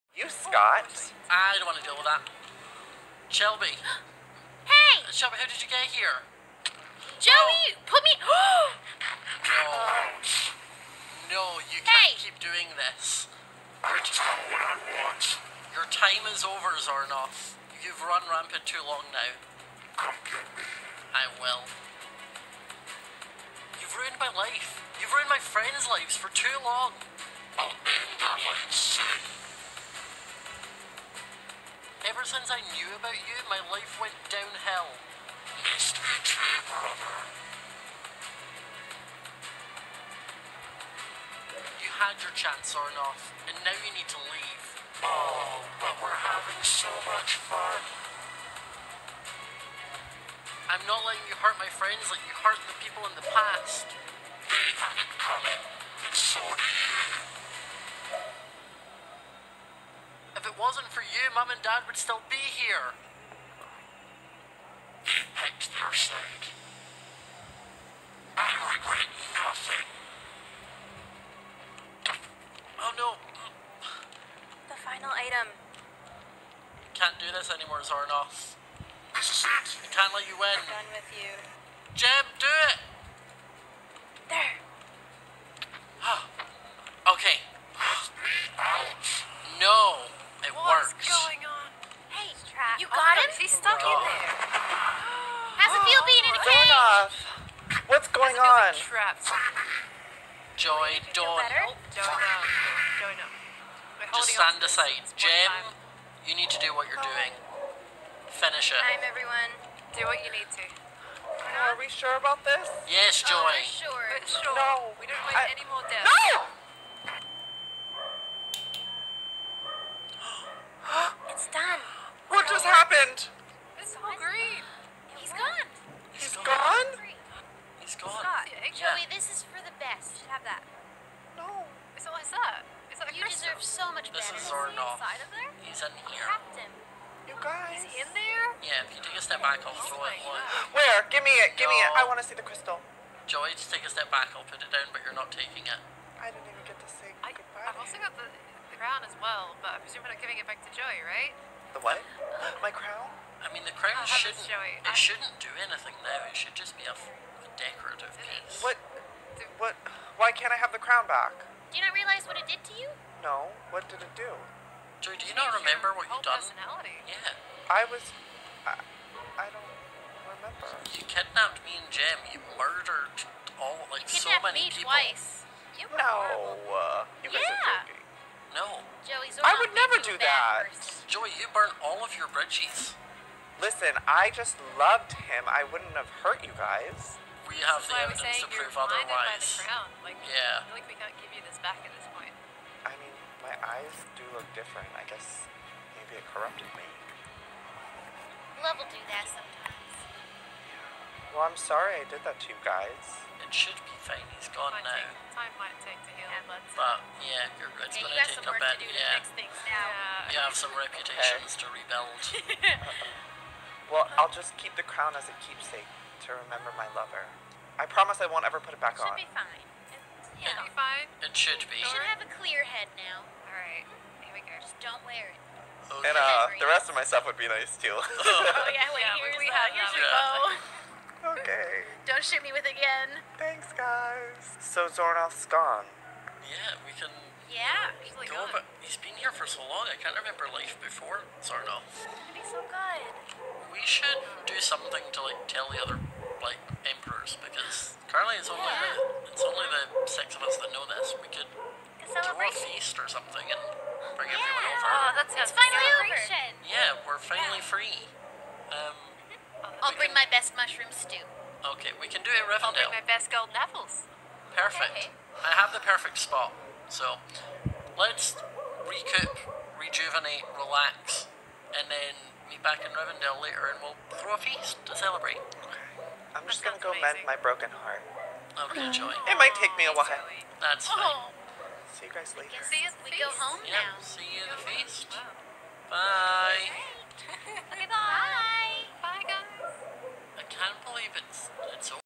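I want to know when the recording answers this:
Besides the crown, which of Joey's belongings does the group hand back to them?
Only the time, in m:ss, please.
3:50.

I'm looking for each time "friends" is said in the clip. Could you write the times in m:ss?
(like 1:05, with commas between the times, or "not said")
0:25, 0:51.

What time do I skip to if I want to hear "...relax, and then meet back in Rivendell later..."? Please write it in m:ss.
4:30.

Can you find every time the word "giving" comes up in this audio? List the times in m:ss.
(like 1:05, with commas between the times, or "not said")
2:30.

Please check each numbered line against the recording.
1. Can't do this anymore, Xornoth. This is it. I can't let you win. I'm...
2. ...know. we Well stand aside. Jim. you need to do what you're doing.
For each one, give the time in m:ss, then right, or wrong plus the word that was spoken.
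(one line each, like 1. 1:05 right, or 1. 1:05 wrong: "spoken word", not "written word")
1. 1:16 right
2. 1:42 wrong: "Just", not "Well".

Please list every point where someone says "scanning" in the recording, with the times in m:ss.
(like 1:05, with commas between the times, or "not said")
not said.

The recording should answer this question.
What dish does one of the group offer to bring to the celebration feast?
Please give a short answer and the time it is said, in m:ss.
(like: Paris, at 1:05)
mushroom stew, at 4:20.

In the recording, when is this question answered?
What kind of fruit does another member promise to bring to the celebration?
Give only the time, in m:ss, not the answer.
4:23.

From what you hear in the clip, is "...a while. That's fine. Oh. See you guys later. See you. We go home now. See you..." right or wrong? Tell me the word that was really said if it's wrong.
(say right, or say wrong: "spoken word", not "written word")
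right.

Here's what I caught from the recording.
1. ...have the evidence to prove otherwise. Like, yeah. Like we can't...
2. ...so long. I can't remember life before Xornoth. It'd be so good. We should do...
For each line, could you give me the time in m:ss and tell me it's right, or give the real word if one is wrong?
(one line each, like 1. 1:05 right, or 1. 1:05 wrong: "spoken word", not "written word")
1. 3:07 right
2. 3:59 right.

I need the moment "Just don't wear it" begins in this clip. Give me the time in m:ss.
3:44.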